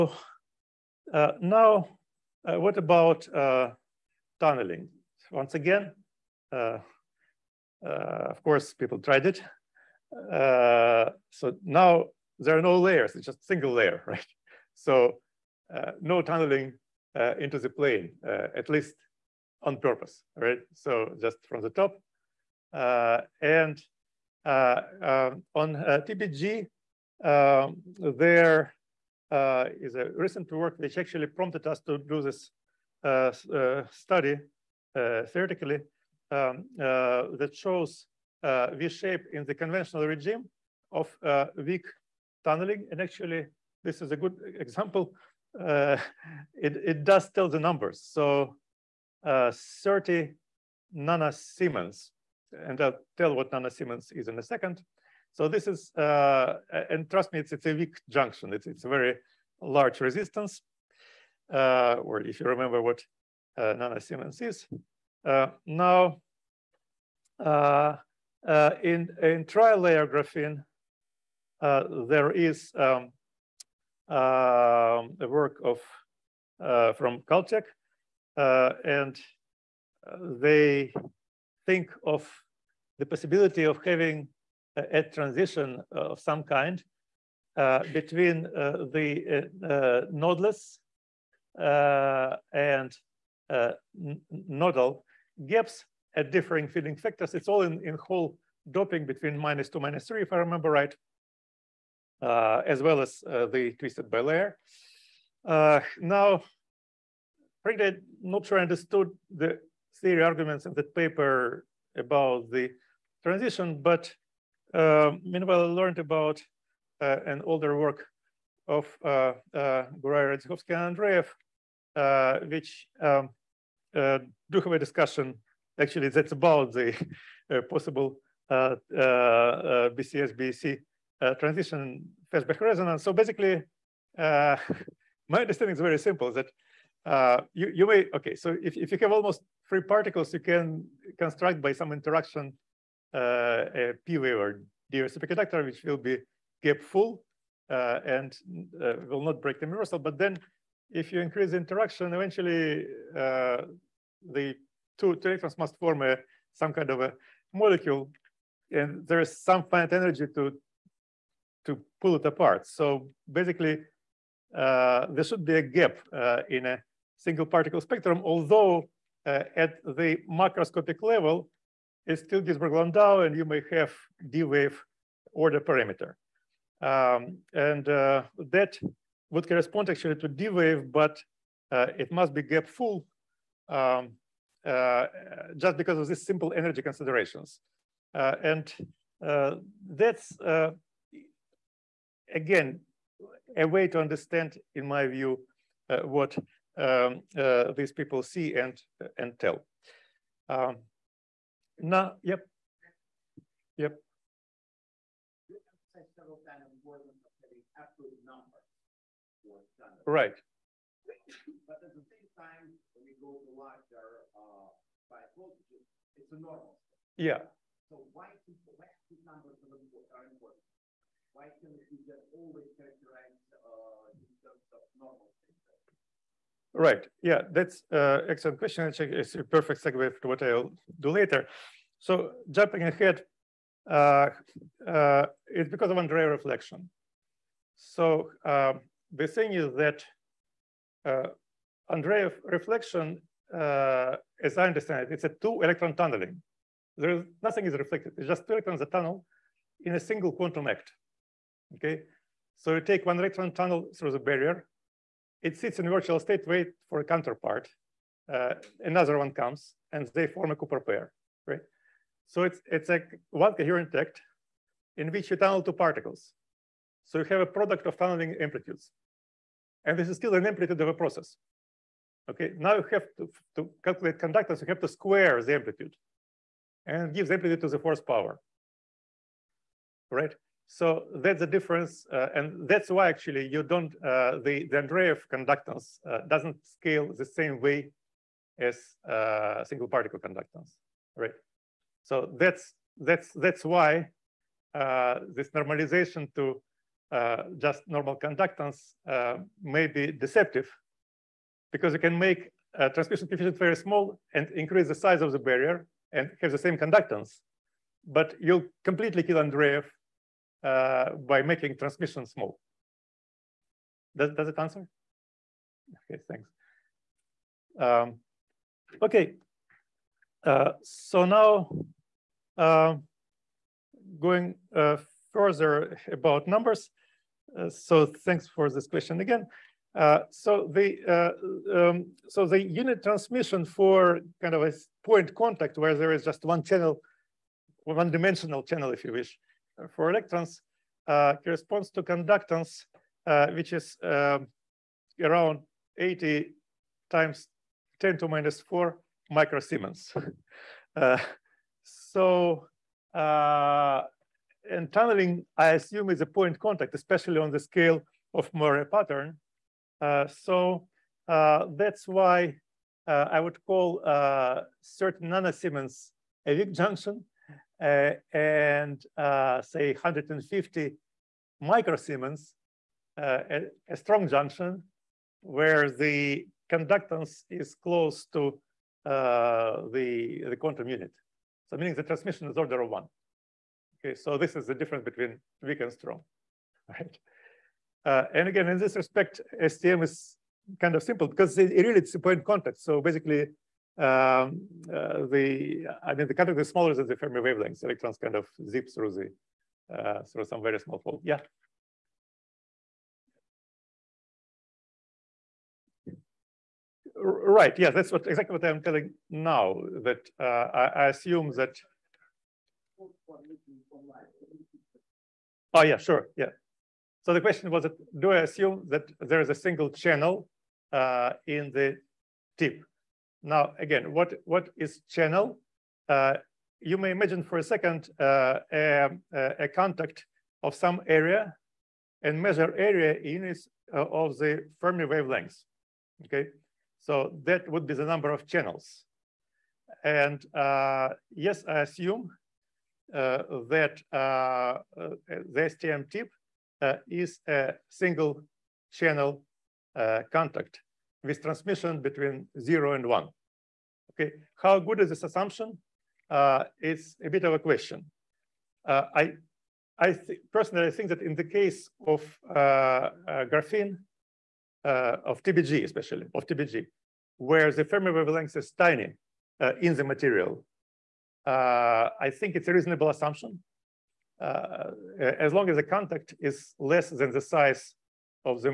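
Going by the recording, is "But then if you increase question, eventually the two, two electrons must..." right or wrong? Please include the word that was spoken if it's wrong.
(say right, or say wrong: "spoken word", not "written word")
wrong: "interaction", not "question".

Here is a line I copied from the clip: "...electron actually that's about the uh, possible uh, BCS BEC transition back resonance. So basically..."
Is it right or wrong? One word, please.
wrong.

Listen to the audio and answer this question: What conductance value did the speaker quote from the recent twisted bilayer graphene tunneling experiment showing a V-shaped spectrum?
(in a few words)
30 nanosiemens.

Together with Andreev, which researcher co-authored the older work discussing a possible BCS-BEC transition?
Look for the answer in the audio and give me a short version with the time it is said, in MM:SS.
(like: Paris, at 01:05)
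Radzihovsky, at 02:00.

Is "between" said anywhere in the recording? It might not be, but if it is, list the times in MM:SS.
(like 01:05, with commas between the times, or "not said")
01:27, 01:39, 06:25, 07:32.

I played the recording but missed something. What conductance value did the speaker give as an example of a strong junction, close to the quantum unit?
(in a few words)
150 microsiemens.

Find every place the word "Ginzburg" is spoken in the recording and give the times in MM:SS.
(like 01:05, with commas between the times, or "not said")
02:52.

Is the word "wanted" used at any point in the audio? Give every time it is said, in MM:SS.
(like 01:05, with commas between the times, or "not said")
not said.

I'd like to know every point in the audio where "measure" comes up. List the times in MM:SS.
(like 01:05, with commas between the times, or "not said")
07:12.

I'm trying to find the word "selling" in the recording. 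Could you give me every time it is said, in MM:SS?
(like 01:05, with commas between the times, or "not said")
not said.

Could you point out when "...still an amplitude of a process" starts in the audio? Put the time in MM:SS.
04:30.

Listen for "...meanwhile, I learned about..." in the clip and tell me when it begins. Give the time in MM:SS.
01:55.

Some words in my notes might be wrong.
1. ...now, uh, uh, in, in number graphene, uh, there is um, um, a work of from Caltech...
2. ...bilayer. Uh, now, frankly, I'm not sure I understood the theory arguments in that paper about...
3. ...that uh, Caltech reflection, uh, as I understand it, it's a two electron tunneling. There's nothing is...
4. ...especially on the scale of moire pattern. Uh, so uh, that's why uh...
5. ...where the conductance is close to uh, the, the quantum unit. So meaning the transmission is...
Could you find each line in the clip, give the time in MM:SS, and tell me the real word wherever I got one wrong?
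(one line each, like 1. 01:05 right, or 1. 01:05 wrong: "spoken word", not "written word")
1. 01:05 wrong: "trilayer", not "number"
2. 01:44 right
3. 03:59 wrong: "Andreev", not "Caltech"
4. 05:56 right
5. 06:15 right.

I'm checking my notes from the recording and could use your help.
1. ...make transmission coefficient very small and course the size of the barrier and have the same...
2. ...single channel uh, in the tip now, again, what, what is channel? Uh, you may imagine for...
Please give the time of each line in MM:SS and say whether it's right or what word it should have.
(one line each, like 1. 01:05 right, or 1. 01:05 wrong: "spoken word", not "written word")
1. 05:02 wrong: "increase", not "course"
2. 06:59 right.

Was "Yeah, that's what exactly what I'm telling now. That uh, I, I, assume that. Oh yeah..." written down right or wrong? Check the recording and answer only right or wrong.
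right.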